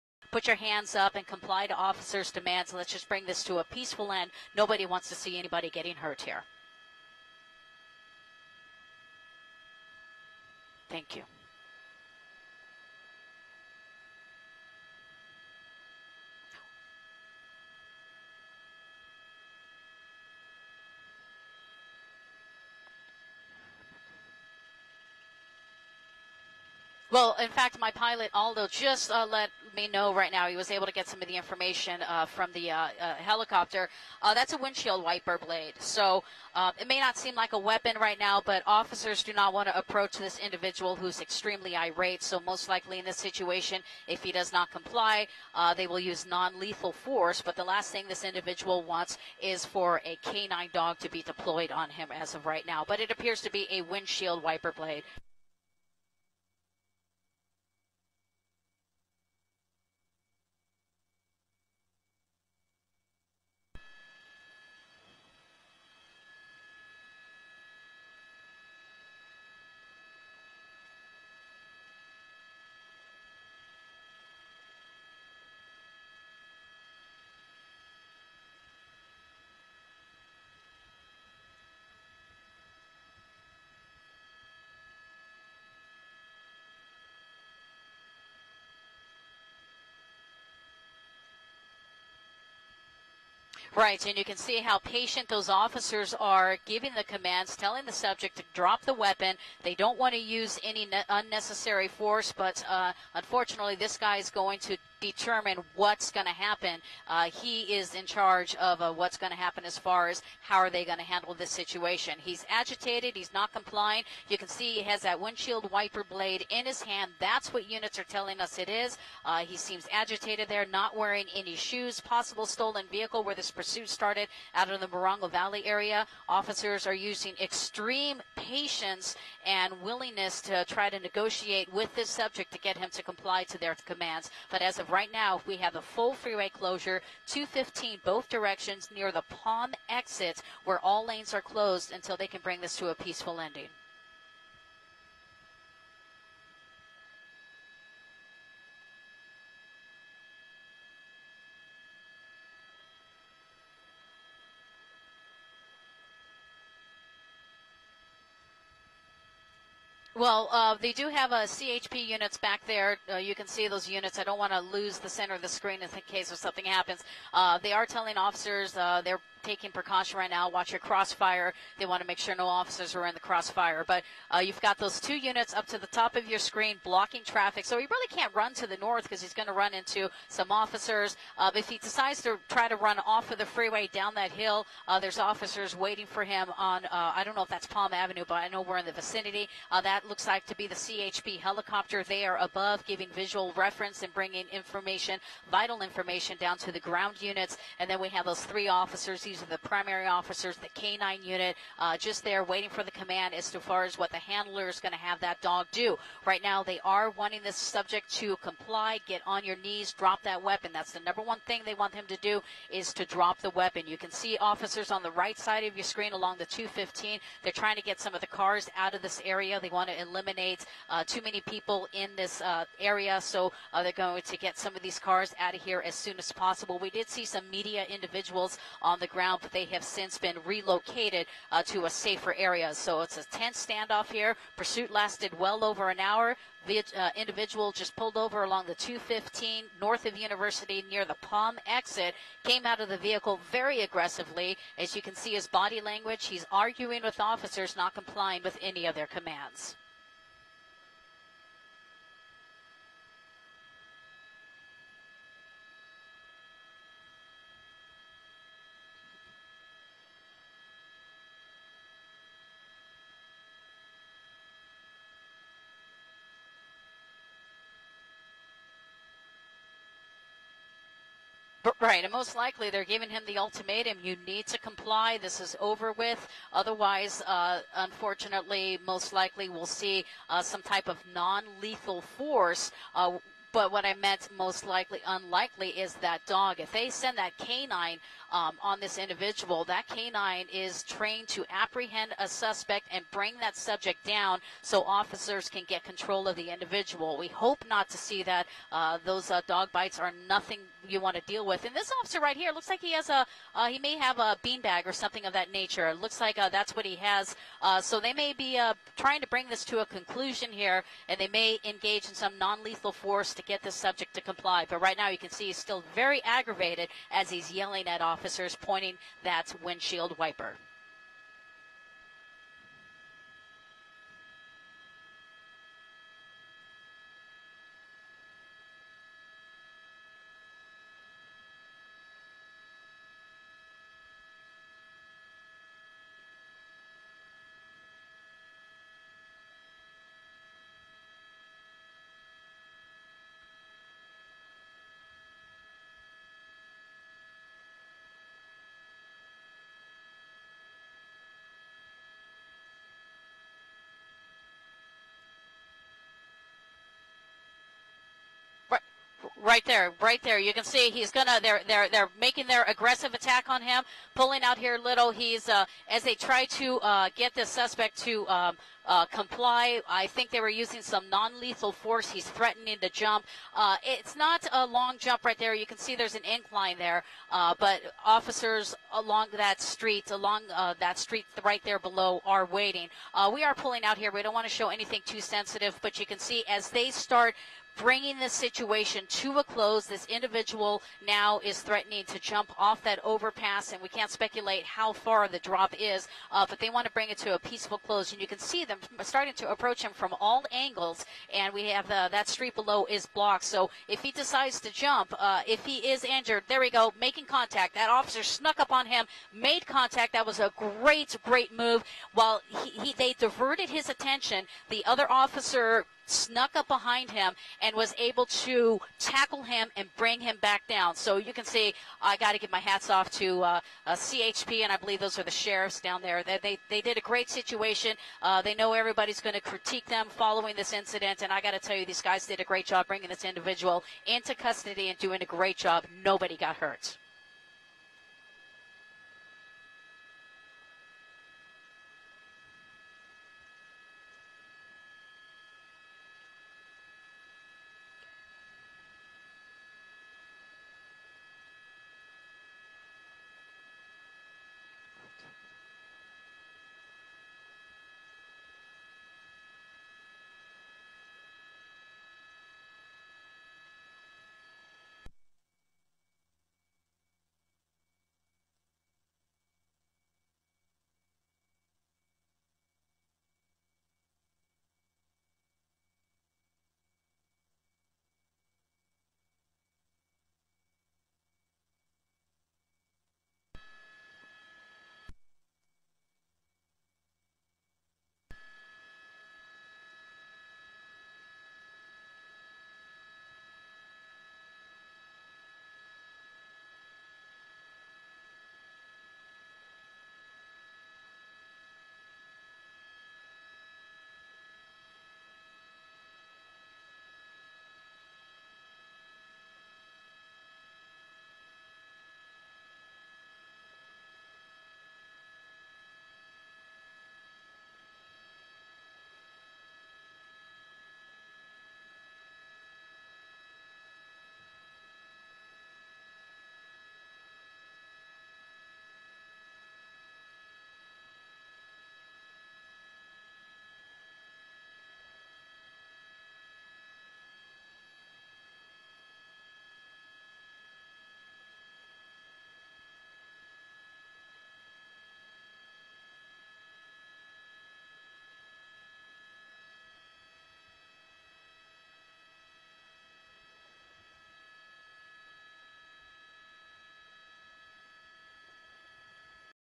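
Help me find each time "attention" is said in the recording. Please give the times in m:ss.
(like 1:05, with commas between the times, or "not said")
6:53.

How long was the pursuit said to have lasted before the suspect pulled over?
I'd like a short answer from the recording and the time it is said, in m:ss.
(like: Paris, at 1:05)
Over an hour, at 3:55.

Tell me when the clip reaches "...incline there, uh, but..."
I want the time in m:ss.
6:16.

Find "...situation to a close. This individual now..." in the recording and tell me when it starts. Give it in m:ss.
6:28.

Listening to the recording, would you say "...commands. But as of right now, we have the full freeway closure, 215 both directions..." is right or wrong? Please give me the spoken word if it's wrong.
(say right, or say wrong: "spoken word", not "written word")
right.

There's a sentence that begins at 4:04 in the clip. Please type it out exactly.
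As you can see his body language, he's arguing with officers, not complying with any of their commands.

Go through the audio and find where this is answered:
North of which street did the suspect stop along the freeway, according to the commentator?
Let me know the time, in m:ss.
4:00.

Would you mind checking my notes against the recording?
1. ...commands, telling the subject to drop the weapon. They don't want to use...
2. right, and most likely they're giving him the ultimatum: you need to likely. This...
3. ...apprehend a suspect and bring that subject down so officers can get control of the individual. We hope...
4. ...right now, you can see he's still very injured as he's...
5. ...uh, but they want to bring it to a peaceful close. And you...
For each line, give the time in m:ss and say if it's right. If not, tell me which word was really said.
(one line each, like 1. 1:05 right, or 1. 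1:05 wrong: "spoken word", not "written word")
1. 1:37 right
2. 4:31 wrong: "comply", not "likely"
3. 4:51 right
4. 5:14 wrong: "aggravated", not "injured"
5. 6:36 right.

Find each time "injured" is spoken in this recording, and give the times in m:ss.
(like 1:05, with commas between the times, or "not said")
6:46.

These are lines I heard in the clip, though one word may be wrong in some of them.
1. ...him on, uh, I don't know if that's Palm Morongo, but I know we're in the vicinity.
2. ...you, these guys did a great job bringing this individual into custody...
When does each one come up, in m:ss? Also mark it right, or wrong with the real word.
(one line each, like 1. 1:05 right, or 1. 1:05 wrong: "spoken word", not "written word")
1. 3:06 wrong: "Avenue", not "Morongo"
2. 7:11 right.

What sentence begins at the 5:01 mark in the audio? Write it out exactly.
And this officer right here looks like he has a, uh, he may have a beanbag or something of that nature.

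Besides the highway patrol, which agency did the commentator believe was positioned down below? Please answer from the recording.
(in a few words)
Sheriffs.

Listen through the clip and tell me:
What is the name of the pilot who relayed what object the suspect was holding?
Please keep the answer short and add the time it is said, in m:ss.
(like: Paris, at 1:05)
Aldo, at 0:28.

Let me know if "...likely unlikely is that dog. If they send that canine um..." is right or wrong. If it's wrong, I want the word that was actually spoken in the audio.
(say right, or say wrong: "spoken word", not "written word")
right.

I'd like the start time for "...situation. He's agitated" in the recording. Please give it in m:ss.
1:51.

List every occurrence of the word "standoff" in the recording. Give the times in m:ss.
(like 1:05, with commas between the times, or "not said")
3:53.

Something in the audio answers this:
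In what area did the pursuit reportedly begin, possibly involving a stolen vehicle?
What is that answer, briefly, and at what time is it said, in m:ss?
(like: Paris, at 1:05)
Morongo Valley, at 2:04.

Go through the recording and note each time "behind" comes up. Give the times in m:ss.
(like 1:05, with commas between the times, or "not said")
6:56.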